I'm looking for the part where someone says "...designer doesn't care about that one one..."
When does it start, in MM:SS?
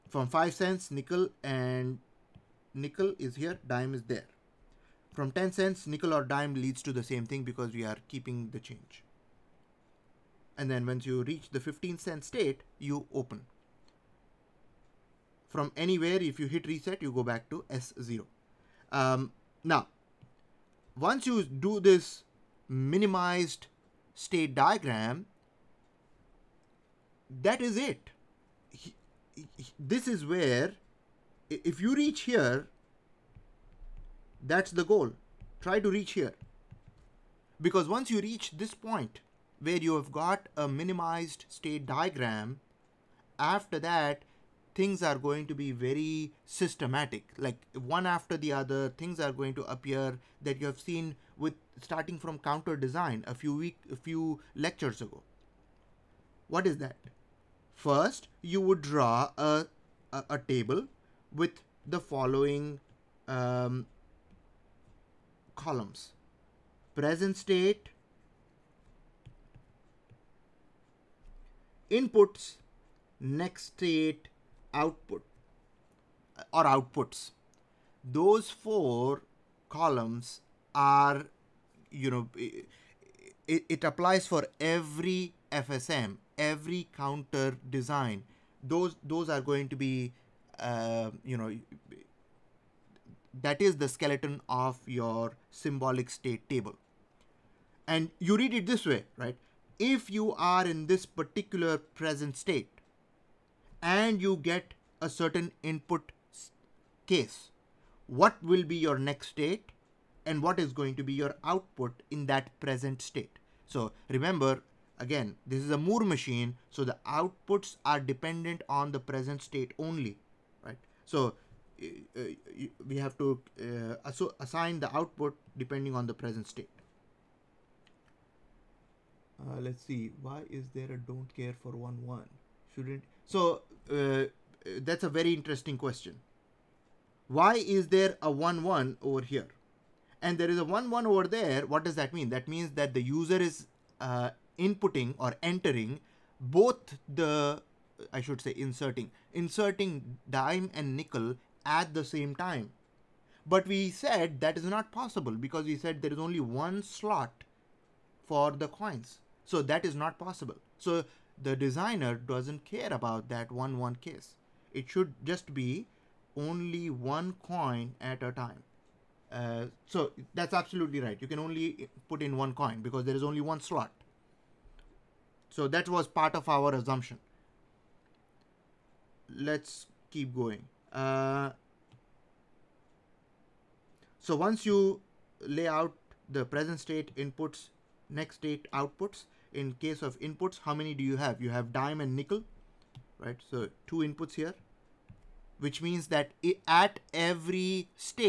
02:41.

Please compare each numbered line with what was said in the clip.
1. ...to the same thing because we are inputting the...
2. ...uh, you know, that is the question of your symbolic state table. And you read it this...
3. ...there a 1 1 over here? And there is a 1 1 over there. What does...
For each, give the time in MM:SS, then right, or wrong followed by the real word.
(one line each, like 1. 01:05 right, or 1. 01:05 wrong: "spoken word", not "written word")
1. 00:06 wrong: "keeping", not "inputting"
2. 01:30 wrong: "skeleton", not "question"
3. 02:17 right.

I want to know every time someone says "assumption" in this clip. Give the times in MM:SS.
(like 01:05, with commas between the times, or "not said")
02:56.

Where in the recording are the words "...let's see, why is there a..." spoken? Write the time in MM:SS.
02:09.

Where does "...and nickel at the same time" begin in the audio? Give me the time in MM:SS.
02:30.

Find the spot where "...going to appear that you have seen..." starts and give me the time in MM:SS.
00:49.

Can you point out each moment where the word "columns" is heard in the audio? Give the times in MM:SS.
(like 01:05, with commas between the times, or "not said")
01:05, 01:19.